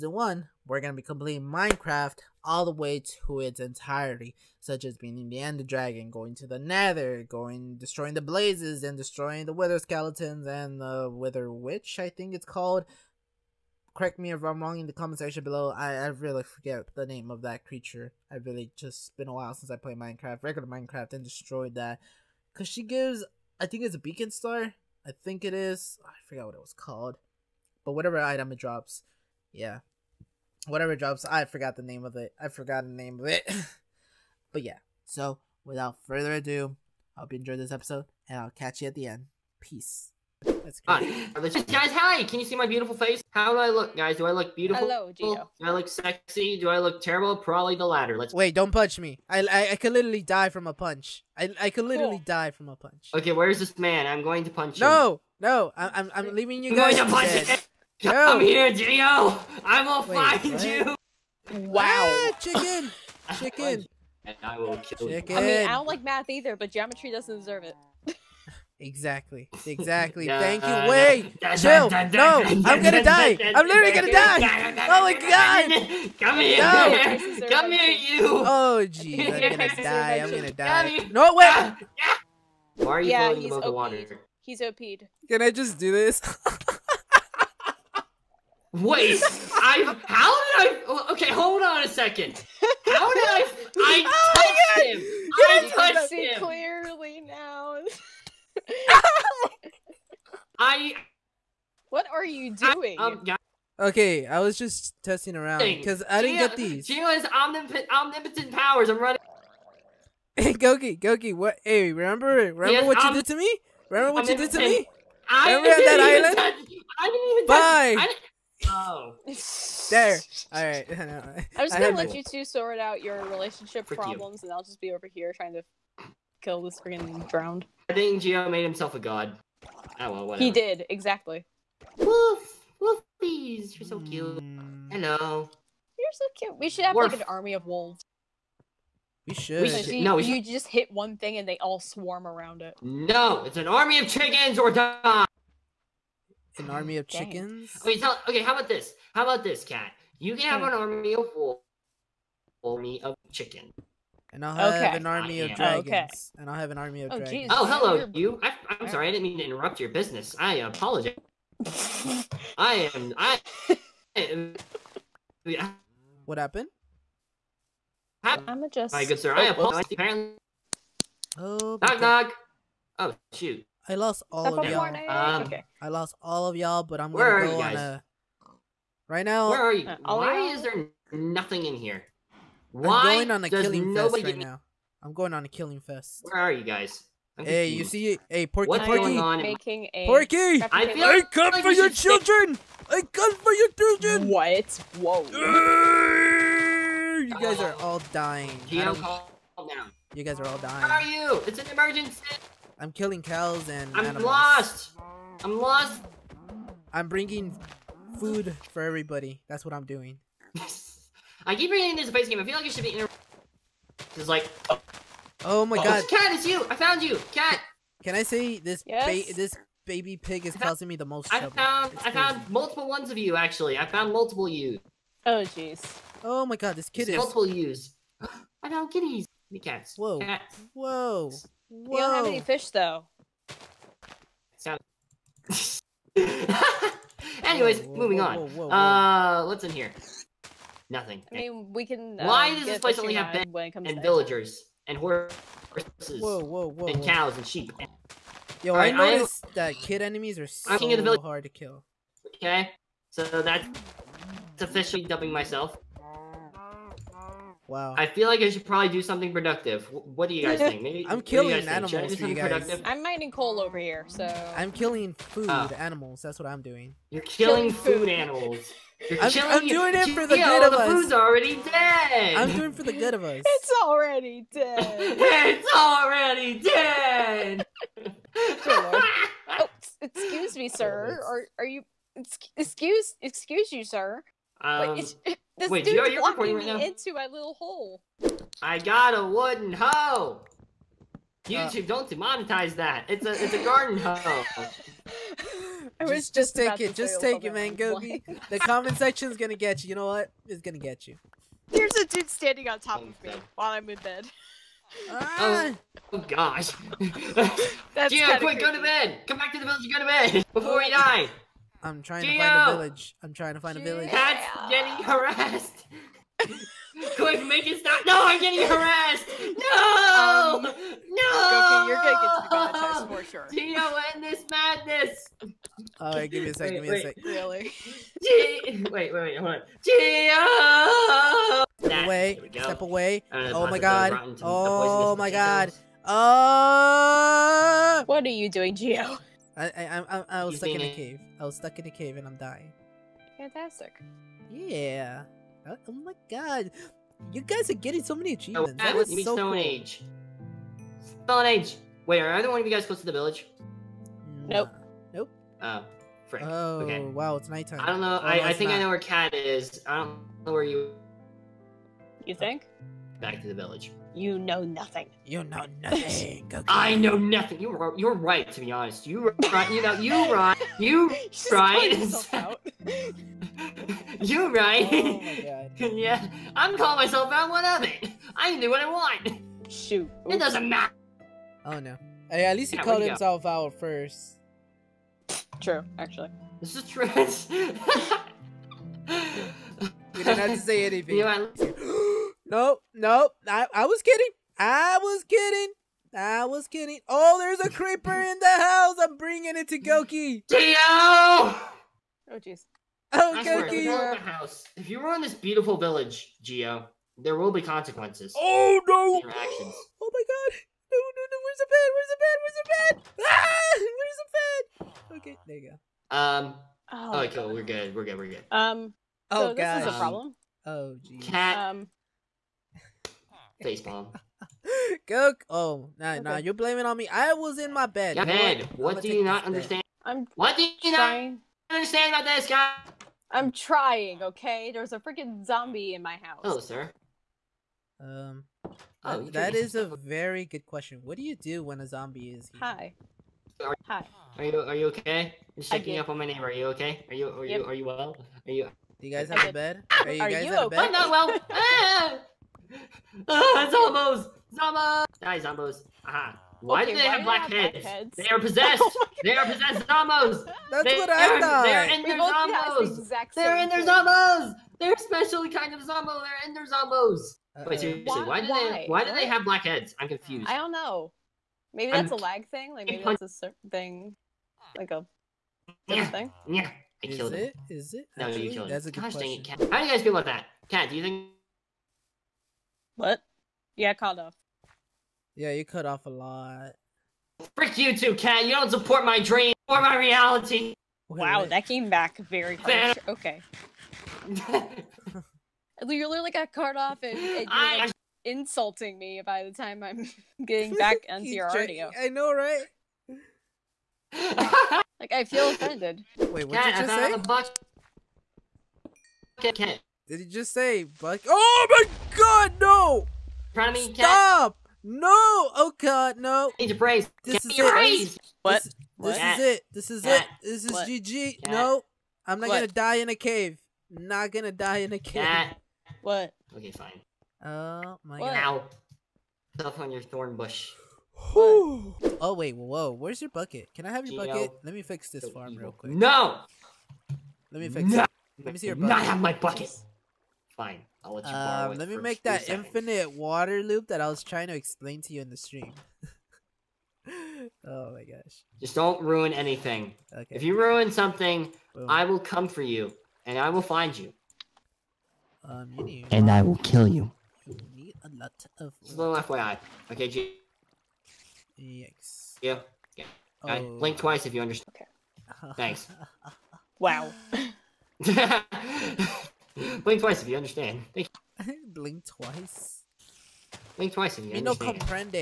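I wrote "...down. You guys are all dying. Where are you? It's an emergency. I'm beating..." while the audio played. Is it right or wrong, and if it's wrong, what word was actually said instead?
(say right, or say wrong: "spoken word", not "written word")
wrong: "killing", not "beating".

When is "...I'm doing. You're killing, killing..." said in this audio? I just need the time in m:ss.
4:26.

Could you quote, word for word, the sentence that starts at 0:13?
Correct me if I'm wrong in the comment section below.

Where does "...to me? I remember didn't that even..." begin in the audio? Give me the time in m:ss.
1:54.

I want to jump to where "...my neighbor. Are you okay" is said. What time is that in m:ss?
7:26.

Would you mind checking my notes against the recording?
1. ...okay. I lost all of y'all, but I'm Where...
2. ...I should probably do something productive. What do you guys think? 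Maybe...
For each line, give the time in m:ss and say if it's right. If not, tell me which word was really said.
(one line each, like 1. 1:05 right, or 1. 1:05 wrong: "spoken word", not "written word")
1. 2:55 right
2. 4:18 right.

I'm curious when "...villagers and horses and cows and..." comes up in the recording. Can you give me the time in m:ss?
4:04.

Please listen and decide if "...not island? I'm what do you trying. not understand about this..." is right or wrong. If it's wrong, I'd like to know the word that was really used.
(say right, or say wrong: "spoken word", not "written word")
wrong: "understand", not "island".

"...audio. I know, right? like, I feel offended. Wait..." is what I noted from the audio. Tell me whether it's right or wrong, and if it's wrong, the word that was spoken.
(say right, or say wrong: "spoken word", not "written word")
right.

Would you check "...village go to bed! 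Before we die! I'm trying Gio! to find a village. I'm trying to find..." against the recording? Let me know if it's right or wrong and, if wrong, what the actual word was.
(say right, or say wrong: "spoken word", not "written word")
right.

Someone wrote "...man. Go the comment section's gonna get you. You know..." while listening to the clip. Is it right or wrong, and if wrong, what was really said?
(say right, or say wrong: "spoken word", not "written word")
right.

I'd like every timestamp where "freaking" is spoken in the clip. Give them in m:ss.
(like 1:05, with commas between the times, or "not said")
2:06, 7:14.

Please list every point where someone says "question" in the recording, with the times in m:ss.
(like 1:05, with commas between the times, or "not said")
7:20, 7:59.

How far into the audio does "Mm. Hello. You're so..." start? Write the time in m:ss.
2:14.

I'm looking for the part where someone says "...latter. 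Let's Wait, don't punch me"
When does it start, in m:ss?
0:47.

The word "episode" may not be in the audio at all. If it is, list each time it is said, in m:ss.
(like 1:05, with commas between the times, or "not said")
0:37.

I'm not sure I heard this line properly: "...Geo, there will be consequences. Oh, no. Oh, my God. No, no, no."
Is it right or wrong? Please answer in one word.
right.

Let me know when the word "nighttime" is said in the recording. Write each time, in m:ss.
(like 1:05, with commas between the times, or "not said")
5:57.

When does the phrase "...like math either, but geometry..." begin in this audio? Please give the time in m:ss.
1:05.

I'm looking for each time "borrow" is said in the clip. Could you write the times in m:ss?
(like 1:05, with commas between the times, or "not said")
9:01.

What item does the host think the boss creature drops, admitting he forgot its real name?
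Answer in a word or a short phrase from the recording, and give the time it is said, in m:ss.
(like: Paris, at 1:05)
beacon star, at 0:23.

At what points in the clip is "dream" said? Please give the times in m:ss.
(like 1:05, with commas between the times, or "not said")
8:09.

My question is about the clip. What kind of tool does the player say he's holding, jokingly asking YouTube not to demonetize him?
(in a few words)
wooden hoe.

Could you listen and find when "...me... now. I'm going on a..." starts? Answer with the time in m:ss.
3:04.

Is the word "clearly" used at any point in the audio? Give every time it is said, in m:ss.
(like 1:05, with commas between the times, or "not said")
1:36.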